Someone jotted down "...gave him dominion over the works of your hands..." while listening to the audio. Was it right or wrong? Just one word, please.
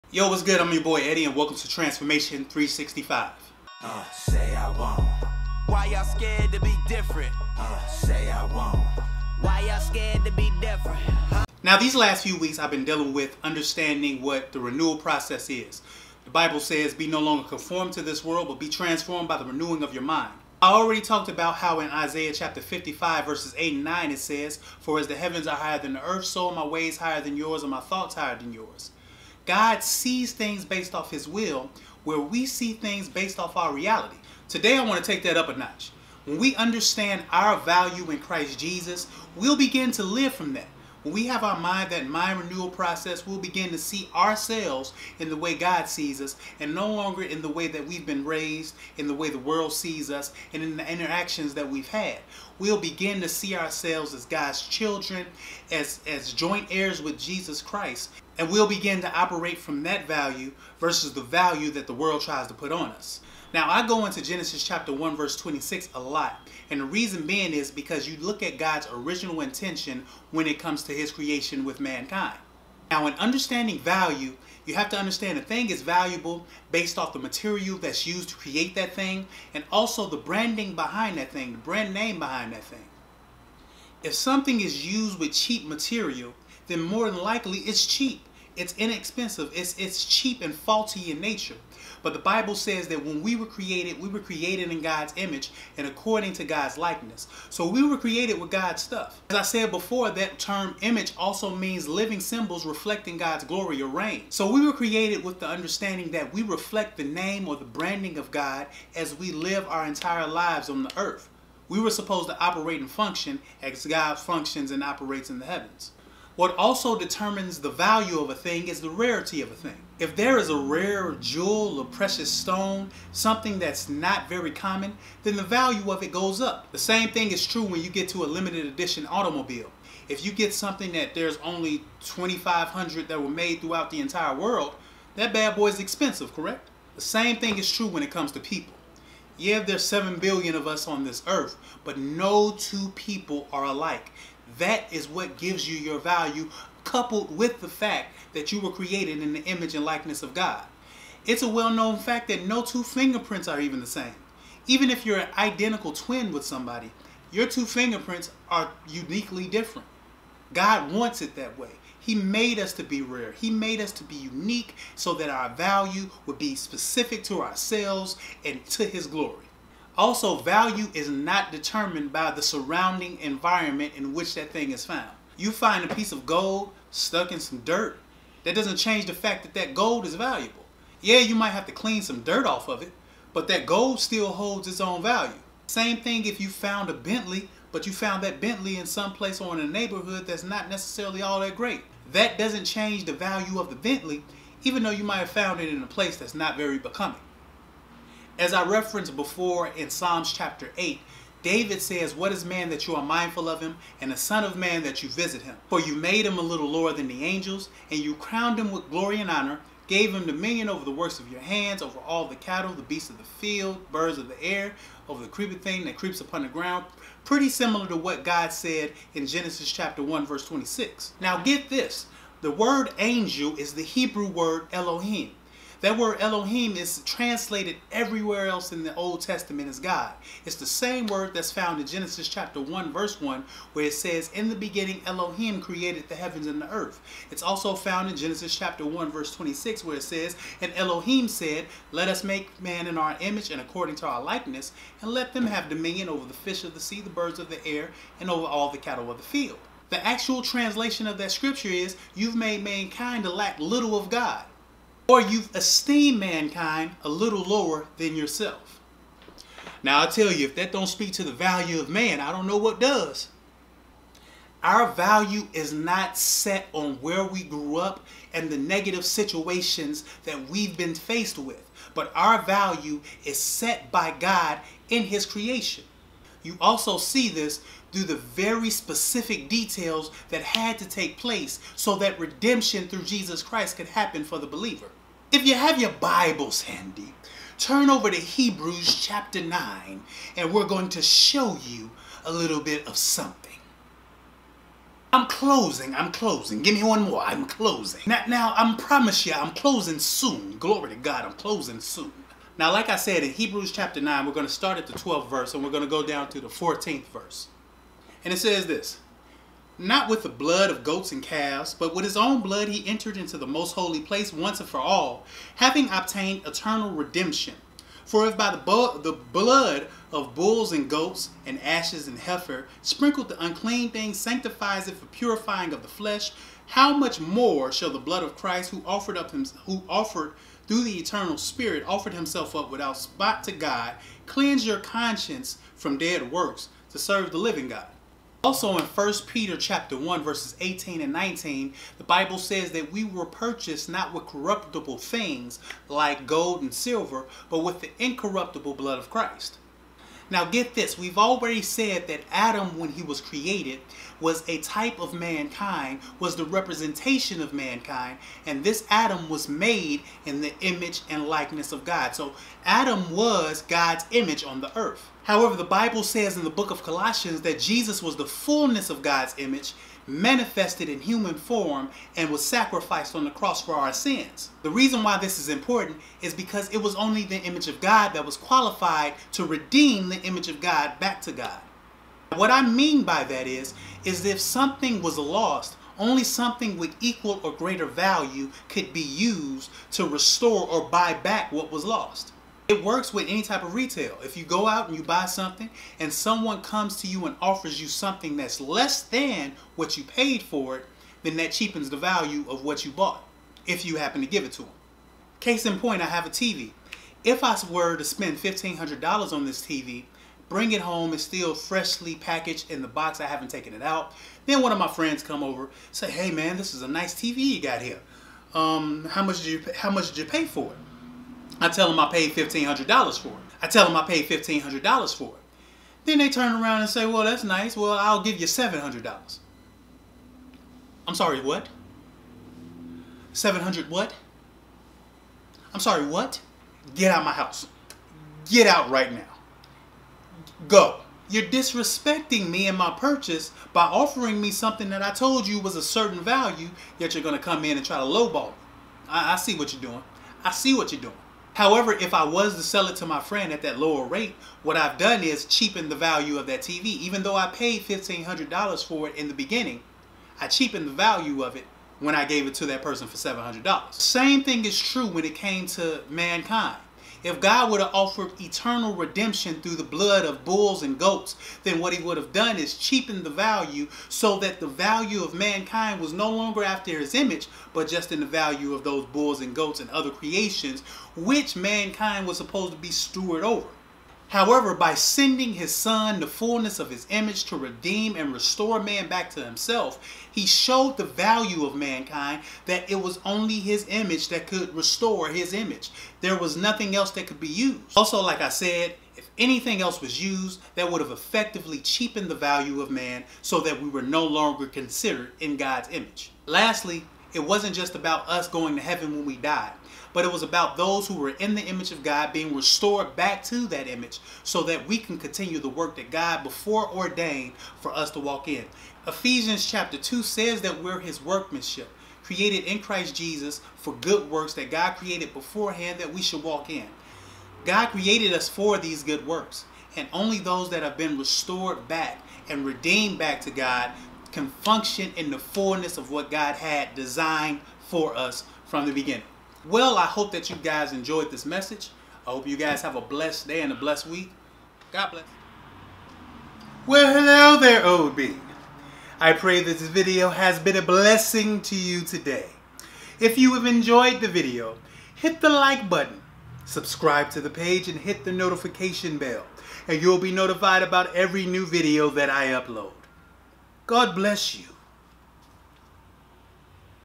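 right.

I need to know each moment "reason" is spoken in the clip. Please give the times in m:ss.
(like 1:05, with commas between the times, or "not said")
1:06, 6:14.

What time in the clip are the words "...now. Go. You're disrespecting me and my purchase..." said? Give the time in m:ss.
7:19.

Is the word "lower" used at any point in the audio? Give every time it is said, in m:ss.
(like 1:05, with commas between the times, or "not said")
3:26, 4:17, 7:33.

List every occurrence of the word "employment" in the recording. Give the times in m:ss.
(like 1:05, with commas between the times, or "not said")
not said.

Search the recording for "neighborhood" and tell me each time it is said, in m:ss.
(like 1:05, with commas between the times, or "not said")
3:09.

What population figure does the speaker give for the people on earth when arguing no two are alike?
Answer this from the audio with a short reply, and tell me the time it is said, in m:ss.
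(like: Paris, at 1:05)
7 billion, at 2:19.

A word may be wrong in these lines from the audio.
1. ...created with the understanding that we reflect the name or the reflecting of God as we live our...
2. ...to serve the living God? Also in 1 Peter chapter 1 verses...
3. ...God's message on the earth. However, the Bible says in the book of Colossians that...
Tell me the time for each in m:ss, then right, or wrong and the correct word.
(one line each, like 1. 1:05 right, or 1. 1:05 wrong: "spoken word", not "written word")
1. 1:44 wrong: "branding", not "reflecting"
2. 5:36 right
3. 6:03 wrong: "image", not "message".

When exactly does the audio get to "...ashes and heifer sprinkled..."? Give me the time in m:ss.
5:21.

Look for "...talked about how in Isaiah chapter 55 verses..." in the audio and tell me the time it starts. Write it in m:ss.
0:20.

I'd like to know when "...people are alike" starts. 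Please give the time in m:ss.
2:22.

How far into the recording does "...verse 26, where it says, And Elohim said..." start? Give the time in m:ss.
3:59.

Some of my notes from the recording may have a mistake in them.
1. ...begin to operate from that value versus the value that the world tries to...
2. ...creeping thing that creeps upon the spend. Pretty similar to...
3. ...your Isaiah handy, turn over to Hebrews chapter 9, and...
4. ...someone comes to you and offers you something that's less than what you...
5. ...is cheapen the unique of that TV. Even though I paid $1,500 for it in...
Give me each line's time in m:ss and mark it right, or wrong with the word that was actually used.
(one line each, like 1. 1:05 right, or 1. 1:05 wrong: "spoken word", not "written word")
1. 0:58 right
2. 3:35 wrong: "ground", not "spend"
3. 4:45 wrong: "Bibles", not "Isaiah"
4. 6:36 right
5. 7:35 wrong: "value", not "unique".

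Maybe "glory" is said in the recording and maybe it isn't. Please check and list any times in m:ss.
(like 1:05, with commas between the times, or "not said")
1:43, 2:49, 3:28, 5:00.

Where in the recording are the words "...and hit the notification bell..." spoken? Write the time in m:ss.
9:17.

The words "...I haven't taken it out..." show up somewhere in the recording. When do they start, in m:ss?
6:53.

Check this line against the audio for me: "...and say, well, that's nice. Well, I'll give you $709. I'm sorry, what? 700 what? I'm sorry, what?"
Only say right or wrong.
wrong.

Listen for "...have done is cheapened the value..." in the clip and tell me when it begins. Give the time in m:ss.
7:52.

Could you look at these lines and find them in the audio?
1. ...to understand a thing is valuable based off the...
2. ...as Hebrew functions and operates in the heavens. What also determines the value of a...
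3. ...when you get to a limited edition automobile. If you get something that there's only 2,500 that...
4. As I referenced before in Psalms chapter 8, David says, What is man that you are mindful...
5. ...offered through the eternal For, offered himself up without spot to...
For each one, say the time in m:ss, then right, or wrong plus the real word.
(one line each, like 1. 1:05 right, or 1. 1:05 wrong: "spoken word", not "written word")
1. 1:14 right
2. 1:53 wrong: "God", not "Hebrew"
3. 2:07 right
4. 3:18 right
5. 5:29 wrong: "Spirit", not "For".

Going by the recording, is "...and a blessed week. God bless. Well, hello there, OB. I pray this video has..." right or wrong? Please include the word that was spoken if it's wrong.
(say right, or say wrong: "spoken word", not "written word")
right.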